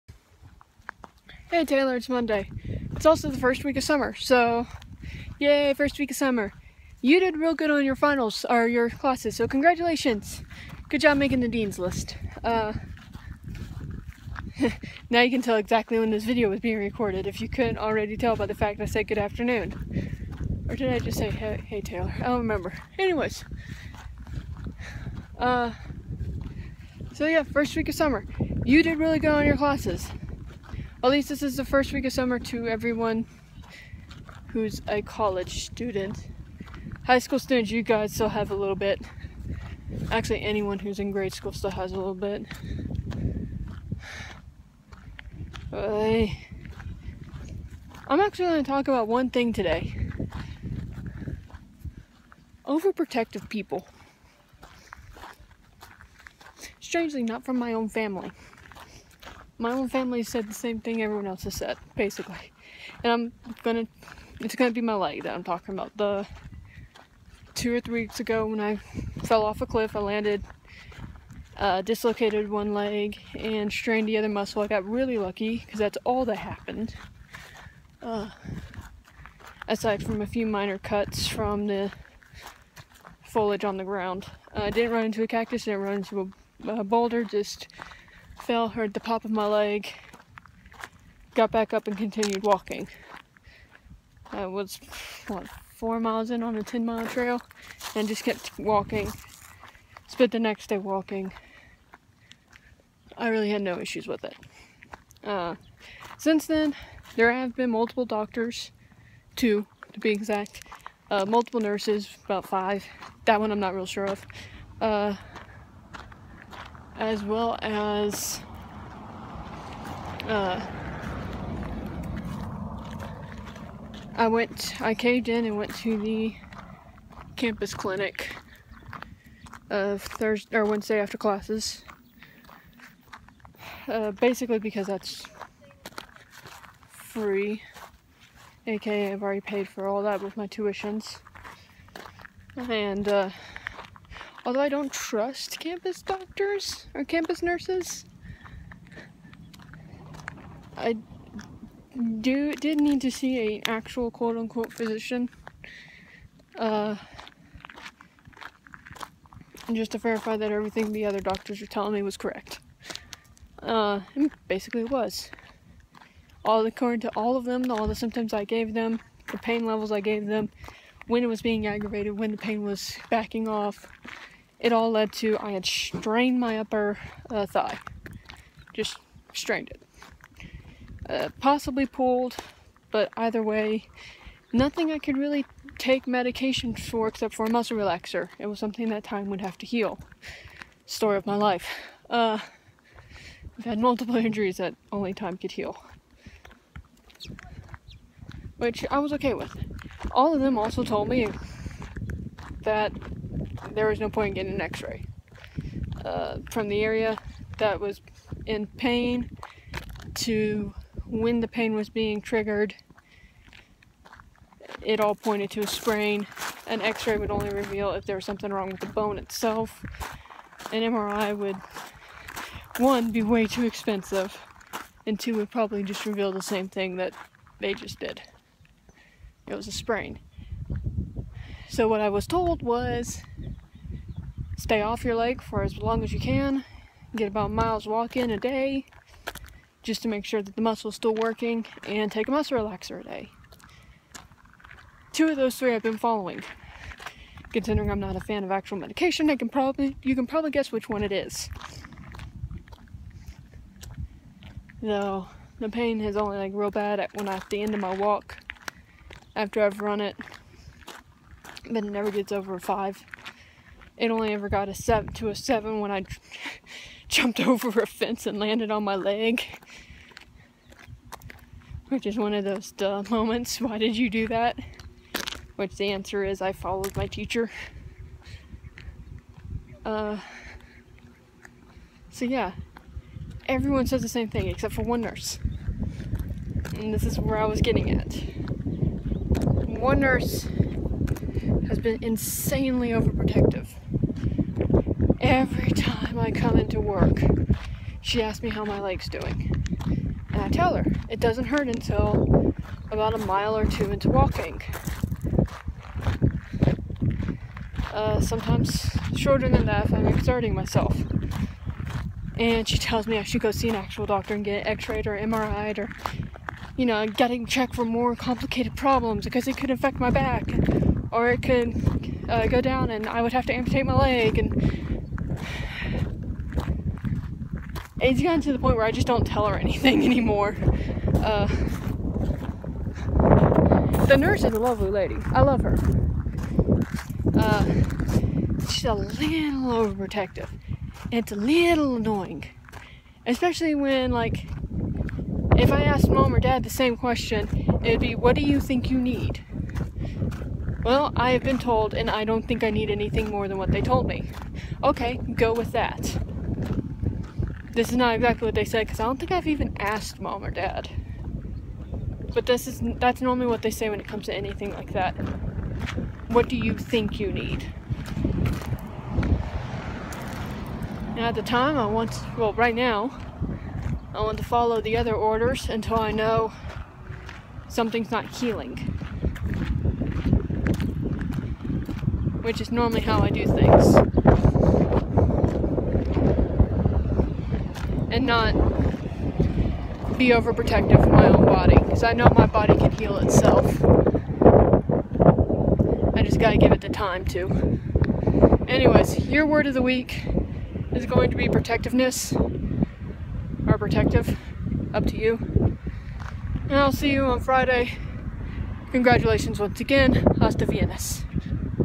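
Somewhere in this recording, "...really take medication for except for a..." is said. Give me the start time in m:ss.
3:05.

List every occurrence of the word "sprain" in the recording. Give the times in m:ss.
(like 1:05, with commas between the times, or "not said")
3:35, 3:49.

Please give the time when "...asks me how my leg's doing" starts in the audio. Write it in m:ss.
4:58.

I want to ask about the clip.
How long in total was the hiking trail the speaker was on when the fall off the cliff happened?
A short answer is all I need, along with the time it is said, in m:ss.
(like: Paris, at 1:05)
10 miles, at 1:36.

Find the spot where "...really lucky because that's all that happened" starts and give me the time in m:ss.
1:14.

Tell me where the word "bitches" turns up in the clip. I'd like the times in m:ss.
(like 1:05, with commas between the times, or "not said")
not said.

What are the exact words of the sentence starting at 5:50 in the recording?
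Well, I have been told, and I don't think I need anything more than what they told me.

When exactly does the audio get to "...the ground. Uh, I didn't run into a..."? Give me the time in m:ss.
1:23.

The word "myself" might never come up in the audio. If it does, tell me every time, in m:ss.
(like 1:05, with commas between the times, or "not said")
5:10.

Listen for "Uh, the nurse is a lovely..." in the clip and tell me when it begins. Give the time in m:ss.
5:31.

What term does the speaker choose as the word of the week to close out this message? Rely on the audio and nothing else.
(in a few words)
Protectiveness.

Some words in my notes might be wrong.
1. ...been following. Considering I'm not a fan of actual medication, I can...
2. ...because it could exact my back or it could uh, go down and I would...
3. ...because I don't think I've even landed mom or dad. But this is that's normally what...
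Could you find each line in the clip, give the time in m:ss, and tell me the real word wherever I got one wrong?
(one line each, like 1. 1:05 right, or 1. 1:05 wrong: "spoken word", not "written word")
1. 4:05 right
2. 5:19 wrong: "affect", not "exact"
3. 5:58 wrong: "asked", not "landed".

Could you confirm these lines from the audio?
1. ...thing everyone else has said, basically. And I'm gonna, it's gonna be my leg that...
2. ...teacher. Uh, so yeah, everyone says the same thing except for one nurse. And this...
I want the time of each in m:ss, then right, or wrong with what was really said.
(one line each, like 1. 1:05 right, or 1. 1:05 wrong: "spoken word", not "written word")
1. 1:00 right
2. 4:37 right.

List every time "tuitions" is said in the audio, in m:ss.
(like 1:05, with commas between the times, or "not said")
2:20.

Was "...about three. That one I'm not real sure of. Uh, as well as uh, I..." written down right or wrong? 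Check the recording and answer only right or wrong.
wrong.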